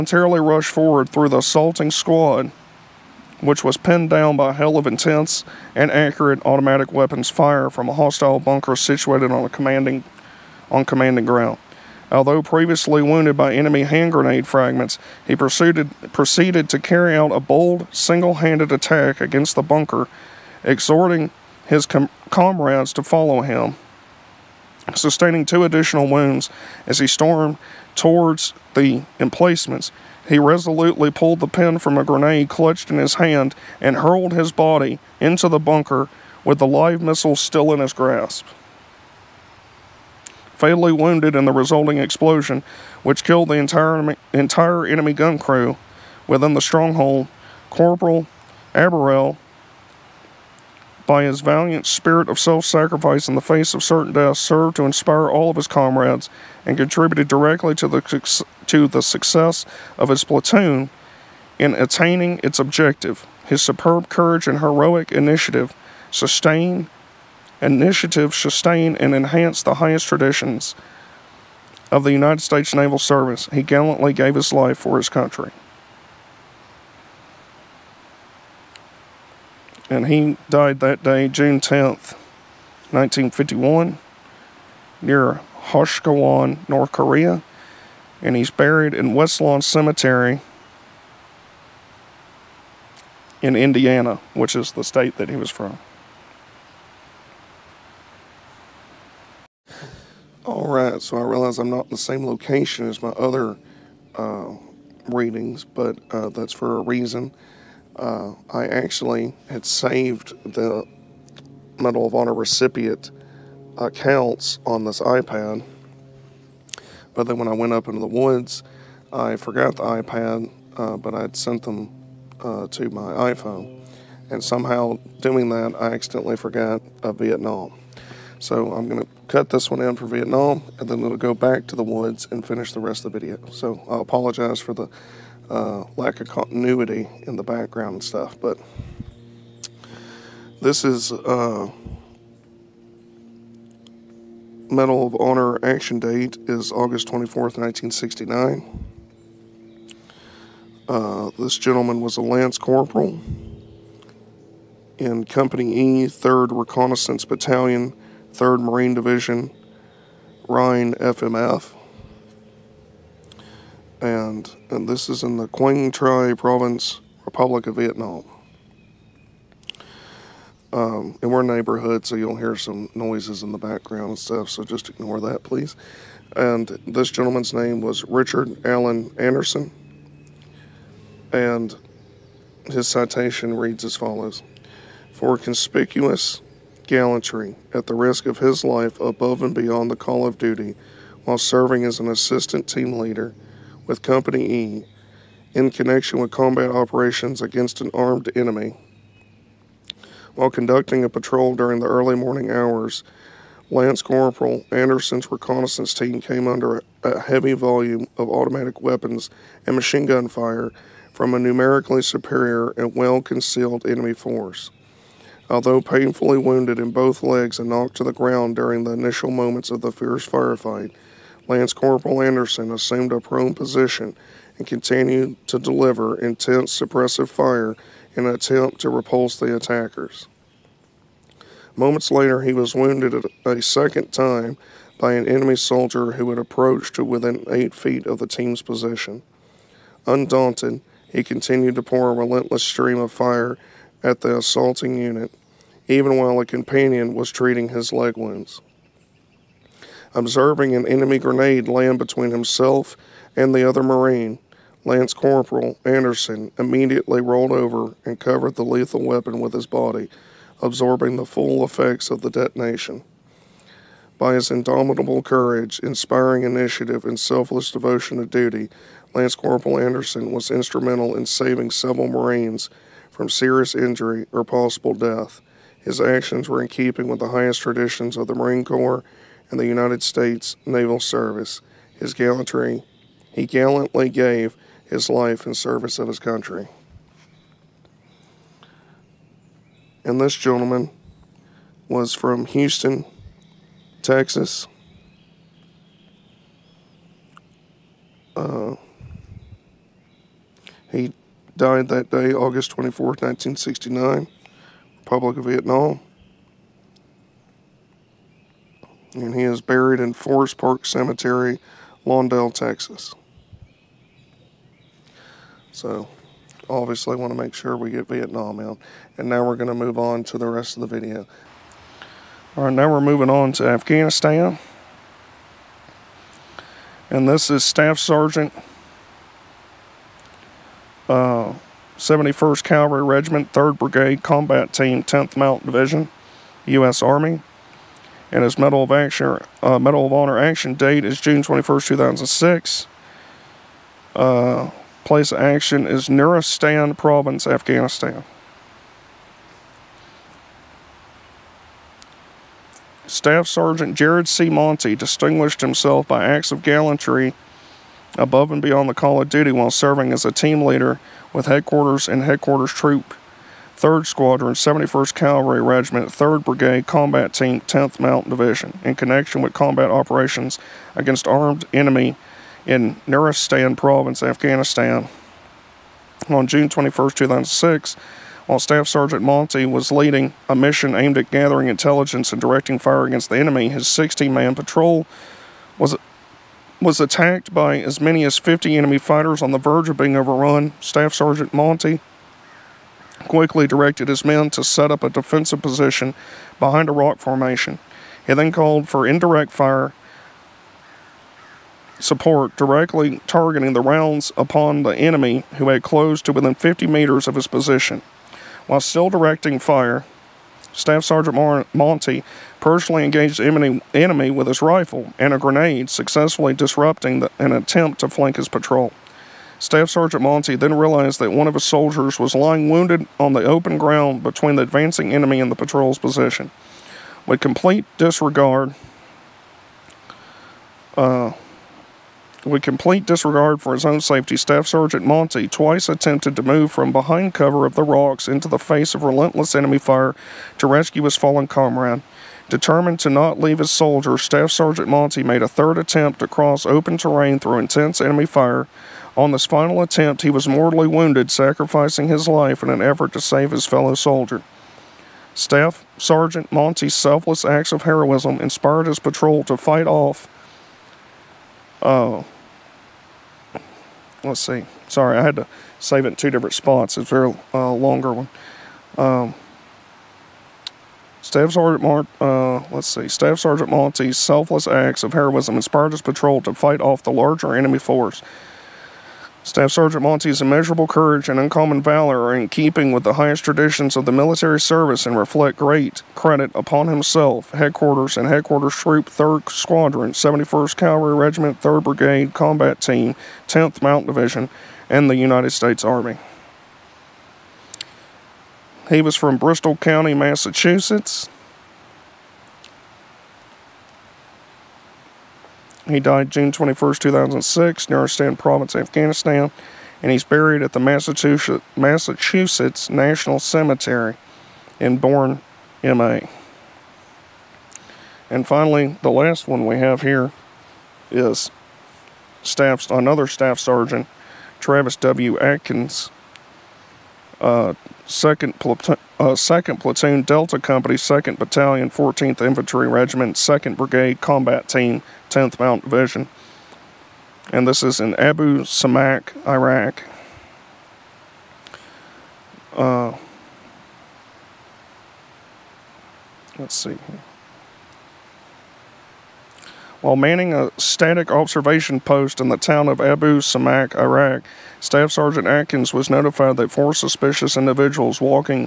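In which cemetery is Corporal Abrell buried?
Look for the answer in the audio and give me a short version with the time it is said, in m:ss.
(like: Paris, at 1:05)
West Lawn Cemetery, at 1:29.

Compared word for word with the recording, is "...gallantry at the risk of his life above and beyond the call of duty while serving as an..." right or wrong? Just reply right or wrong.
right.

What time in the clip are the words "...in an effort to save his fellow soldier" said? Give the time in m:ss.
7:32.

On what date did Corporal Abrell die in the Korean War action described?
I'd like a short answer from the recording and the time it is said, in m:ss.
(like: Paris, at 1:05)
June 10th, 1951, at 1:21.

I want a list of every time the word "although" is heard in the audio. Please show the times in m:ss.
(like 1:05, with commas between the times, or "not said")
0:12, 3:35.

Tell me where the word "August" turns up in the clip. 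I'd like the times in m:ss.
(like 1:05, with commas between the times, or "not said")
2:26, 5:02.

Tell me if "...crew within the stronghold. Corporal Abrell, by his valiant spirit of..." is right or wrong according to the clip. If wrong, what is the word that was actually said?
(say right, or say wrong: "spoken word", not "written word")
right.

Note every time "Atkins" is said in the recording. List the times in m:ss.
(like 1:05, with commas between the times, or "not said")
8:45, 9:15.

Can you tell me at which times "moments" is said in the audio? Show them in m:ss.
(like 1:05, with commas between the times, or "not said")
3:39, 3:51.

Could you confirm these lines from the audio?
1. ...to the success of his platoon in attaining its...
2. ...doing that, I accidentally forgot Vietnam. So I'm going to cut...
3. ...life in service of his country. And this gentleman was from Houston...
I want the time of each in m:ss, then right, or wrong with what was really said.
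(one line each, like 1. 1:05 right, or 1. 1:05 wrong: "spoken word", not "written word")
1. 0:58 right
2. 2:05 right
3. 4:45 right.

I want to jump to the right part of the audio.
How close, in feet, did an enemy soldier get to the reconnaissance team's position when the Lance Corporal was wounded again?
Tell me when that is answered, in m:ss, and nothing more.
3:57.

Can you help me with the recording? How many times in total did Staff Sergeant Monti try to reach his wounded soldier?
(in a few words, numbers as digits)
3.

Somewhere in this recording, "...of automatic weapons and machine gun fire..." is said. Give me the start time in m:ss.
3:28.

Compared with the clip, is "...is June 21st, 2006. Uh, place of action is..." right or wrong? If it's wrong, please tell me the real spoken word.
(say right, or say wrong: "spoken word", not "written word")
right.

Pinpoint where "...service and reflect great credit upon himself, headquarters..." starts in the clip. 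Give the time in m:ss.
8:04.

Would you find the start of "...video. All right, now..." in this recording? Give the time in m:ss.
5:21.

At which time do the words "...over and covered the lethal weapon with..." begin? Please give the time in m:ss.
4:17.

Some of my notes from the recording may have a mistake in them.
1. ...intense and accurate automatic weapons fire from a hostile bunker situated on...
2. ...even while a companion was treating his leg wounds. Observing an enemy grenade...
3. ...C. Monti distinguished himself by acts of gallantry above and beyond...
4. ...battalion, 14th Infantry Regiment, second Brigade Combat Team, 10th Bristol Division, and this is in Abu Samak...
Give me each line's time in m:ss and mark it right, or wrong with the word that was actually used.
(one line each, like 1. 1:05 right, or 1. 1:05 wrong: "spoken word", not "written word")
1. 0:04 right
2. 4:05 right
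3. 5:54 right
4. 8:51 wrong: "Mount", not "Bristol".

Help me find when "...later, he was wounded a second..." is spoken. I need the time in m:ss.
3:52.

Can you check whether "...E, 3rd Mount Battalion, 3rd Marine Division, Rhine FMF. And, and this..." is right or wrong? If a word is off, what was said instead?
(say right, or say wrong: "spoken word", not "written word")
wrong: "Reconnaissance", not "Mount".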